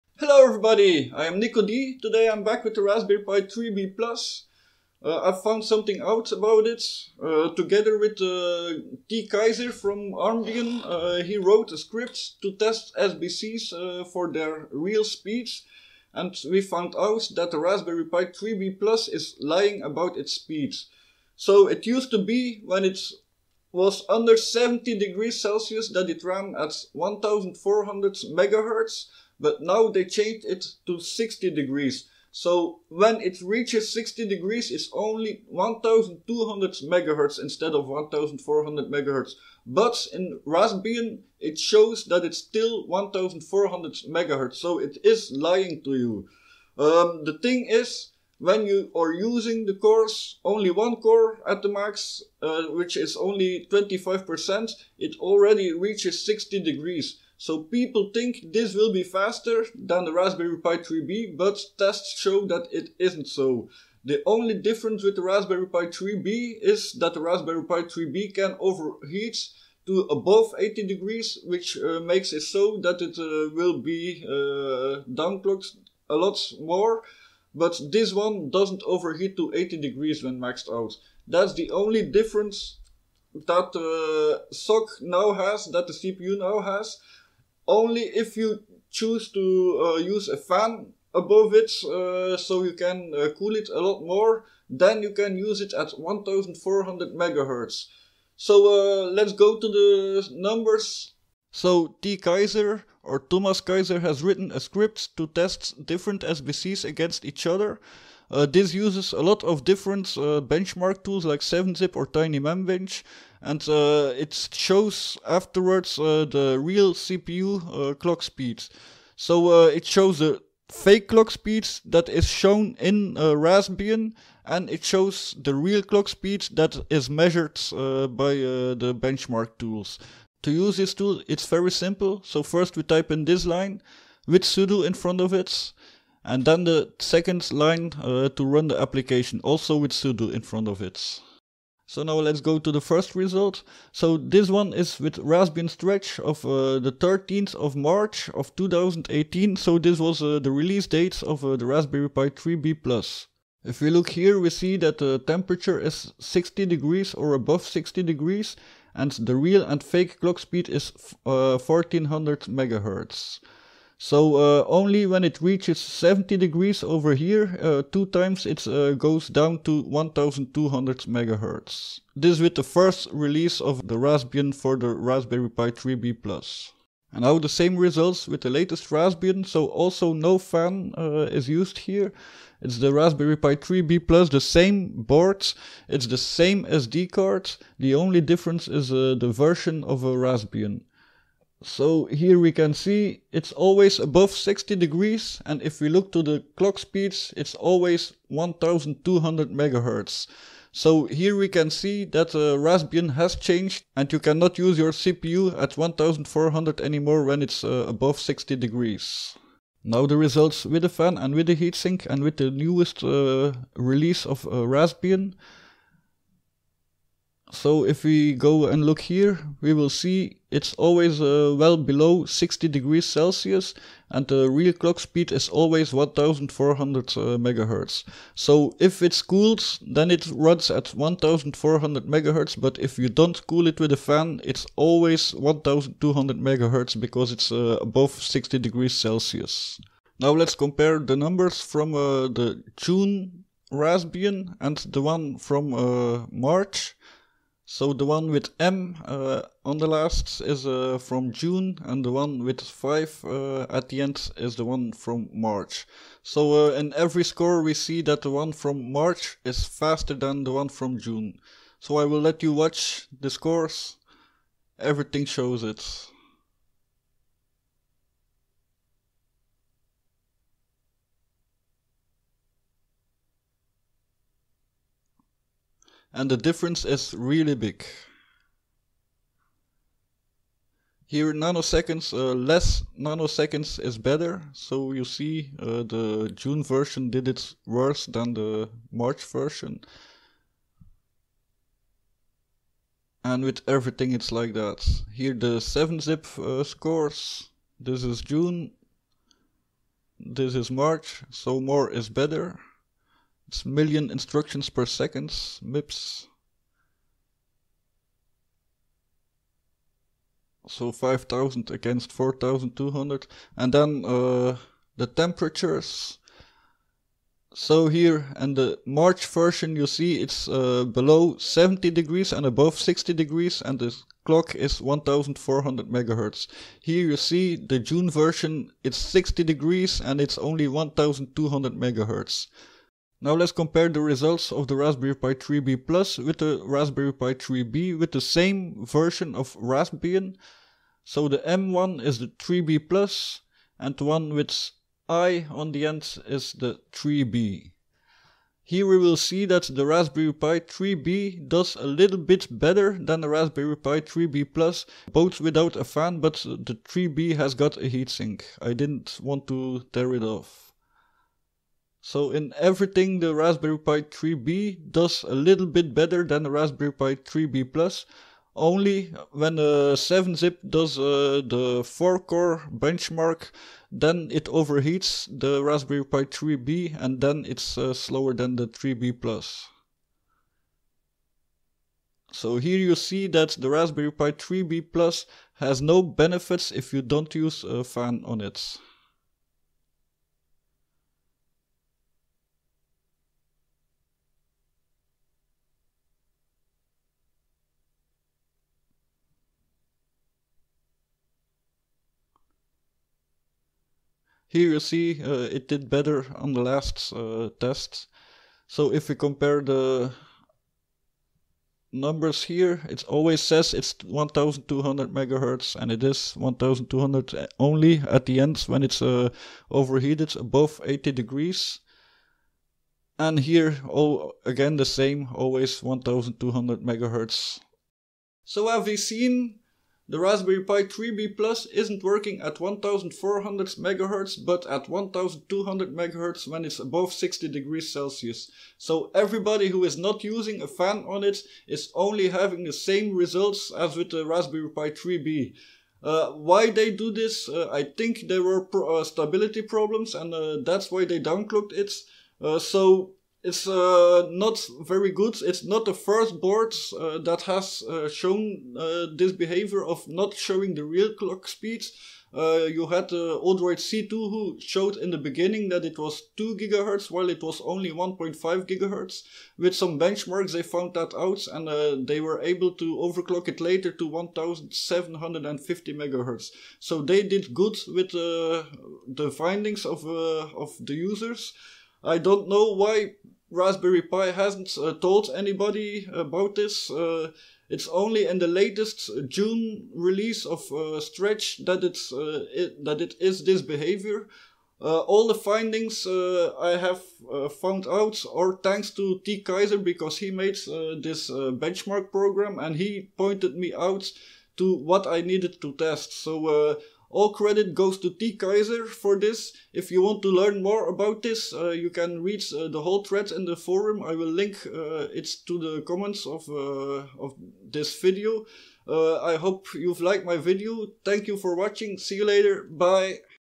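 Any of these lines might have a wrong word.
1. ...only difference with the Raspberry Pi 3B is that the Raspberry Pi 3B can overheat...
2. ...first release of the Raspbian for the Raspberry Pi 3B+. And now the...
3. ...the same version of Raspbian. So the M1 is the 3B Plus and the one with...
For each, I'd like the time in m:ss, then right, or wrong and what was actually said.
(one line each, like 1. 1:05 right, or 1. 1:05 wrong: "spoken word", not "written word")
1. 1:04 right
2. 2:52 right
3. 5:38 right.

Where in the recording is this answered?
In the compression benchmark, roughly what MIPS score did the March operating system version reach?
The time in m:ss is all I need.
5:10.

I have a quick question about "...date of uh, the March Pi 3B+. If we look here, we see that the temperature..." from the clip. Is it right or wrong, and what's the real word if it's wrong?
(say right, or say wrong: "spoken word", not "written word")
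wrong: "Raspberry", not "March".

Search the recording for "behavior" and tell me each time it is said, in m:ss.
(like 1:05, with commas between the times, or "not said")
7:39, 8:13.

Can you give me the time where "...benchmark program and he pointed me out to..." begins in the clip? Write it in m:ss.
8:21.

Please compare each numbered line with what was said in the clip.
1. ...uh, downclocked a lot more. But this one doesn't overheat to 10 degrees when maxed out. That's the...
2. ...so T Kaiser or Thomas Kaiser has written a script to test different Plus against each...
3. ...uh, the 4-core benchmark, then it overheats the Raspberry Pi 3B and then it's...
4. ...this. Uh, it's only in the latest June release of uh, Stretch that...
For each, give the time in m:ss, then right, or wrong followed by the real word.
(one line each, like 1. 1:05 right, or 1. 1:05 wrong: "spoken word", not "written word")
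1. 1:14 wrong: "80", not "10"
2. 1:41 wrong: "SBCs", not "Plus"
3. 6:10 right
4. 8:06 right.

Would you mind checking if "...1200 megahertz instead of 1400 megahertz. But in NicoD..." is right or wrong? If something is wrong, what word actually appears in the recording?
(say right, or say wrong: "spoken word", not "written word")
wrong: "Raspbian", not "NicoD".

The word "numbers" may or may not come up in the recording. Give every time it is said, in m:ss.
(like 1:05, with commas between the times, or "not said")
1:40, 4:01, 6:51.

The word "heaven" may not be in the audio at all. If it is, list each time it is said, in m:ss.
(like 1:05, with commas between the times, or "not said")
not said.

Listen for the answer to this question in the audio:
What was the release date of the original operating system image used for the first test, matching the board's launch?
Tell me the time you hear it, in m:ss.
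2:26.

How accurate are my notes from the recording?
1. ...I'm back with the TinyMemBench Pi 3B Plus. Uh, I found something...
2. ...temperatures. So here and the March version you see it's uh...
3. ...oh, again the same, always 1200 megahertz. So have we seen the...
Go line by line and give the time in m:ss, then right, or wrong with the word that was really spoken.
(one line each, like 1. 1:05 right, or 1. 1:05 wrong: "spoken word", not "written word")
1. 0:02 wrong: "Raspberry", not "TinyMemBench"
2. 5:15 right
3. 7:03 right.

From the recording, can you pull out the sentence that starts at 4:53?
And with everything it's like that.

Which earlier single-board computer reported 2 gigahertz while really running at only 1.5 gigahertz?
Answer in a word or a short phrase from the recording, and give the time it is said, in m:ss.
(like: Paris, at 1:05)
Odroid C2, at 7:43.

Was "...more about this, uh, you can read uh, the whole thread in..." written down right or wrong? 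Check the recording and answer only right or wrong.
right.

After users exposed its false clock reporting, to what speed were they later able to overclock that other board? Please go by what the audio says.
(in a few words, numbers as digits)
1750 MHz.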